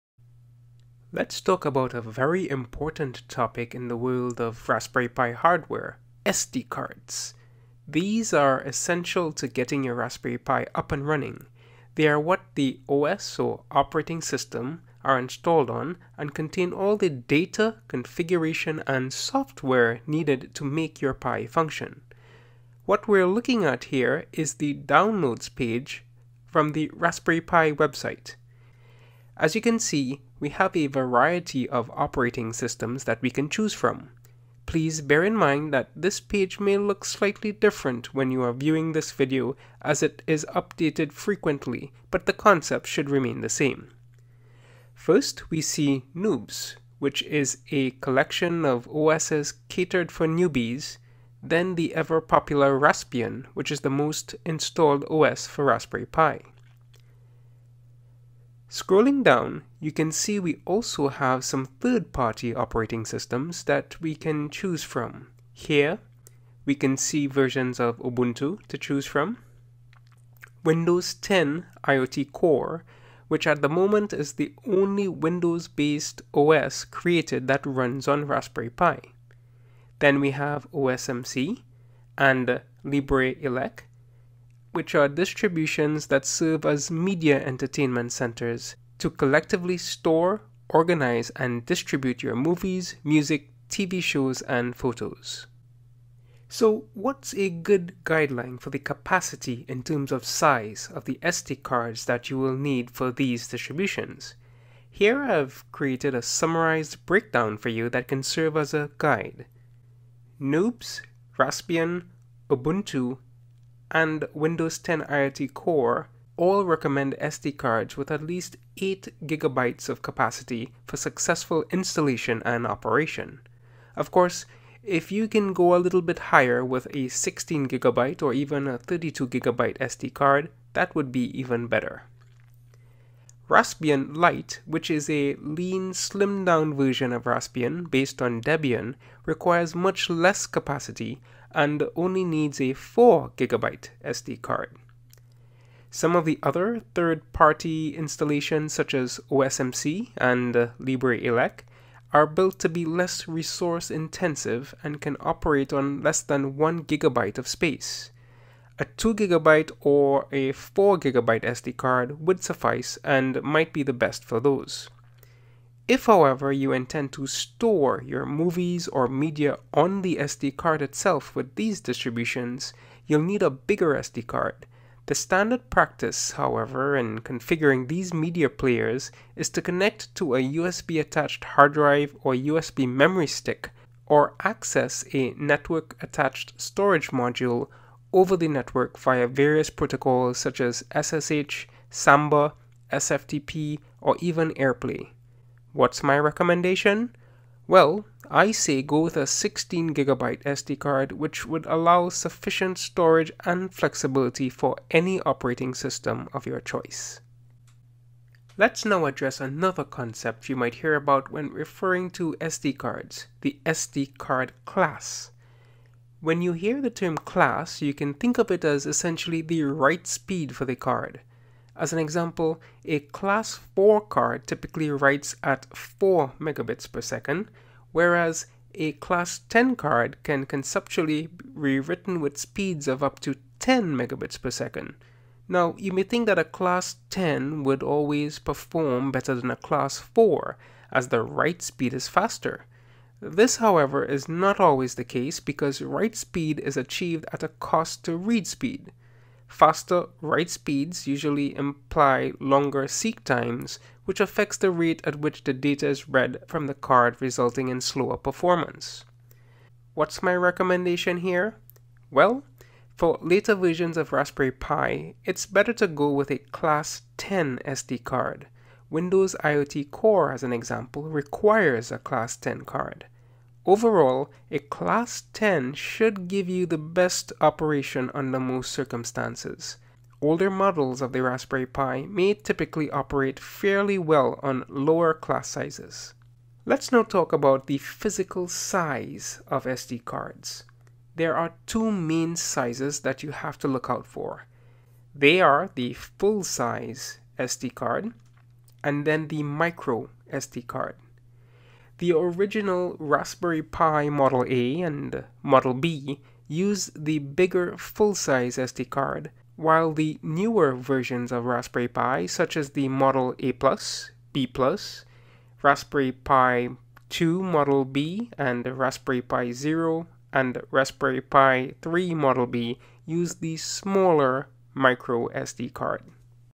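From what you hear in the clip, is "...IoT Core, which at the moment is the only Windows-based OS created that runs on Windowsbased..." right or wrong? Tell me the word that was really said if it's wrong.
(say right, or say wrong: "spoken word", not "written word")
wrong: "Raspberry", not "Windowsbased".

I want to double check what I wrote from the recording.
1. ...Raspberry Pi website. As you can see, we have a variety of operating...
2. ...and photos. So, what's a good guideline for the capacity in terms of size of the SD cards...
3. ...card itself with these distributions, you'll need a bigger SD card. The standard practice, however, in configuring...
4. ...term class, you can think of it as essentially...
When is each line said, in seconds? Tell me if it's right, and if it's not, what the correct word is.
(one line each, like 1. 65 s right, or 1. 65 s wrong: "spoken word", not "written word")
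1. 26 s right
2. 94 s right
3. 170 s right
4. 216 s right.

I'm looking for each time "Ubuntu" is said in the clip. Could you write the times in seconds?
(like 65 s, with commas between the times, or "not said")
67 s, 112 s.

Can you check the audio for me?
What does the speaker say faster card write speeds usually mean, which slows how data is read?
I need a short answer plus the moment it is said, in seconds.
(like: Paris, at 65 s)
longer seek times, at 252 s.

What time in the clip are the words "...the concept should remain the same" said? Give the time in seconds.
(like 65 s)
42 s.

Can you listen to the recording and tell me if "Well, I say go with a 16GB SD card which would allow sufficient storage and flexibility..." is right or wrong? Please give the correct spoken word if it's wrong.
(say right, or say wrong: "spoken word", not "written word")
right.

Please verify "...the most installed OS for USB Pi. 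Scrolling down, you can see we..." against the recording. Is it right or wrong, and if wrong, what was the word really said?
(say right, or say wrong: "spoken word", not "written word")
wrong: "Raspberry", not "USB".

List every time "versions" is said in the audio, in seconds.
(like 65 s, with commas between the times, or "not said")
67 s, 136 s, 263 s, 310 s.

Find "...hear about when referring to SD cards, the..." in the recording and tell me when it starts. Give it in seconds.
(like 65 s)
210 s.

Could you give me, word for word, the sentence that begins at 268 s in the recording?
Windows IoT Core, as an example, requires a Class 10 card.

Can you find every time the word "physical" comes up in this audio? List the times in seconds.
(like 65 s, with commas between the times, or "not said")
287 s.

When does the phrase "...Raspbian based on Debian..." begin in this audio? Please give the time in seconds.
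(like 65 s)
137 s.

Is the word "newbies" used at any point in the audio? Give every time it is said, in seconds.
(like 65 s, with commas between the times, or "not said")
50 s.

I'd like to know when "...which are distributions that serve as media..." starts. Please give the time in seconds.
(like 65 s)
84 s.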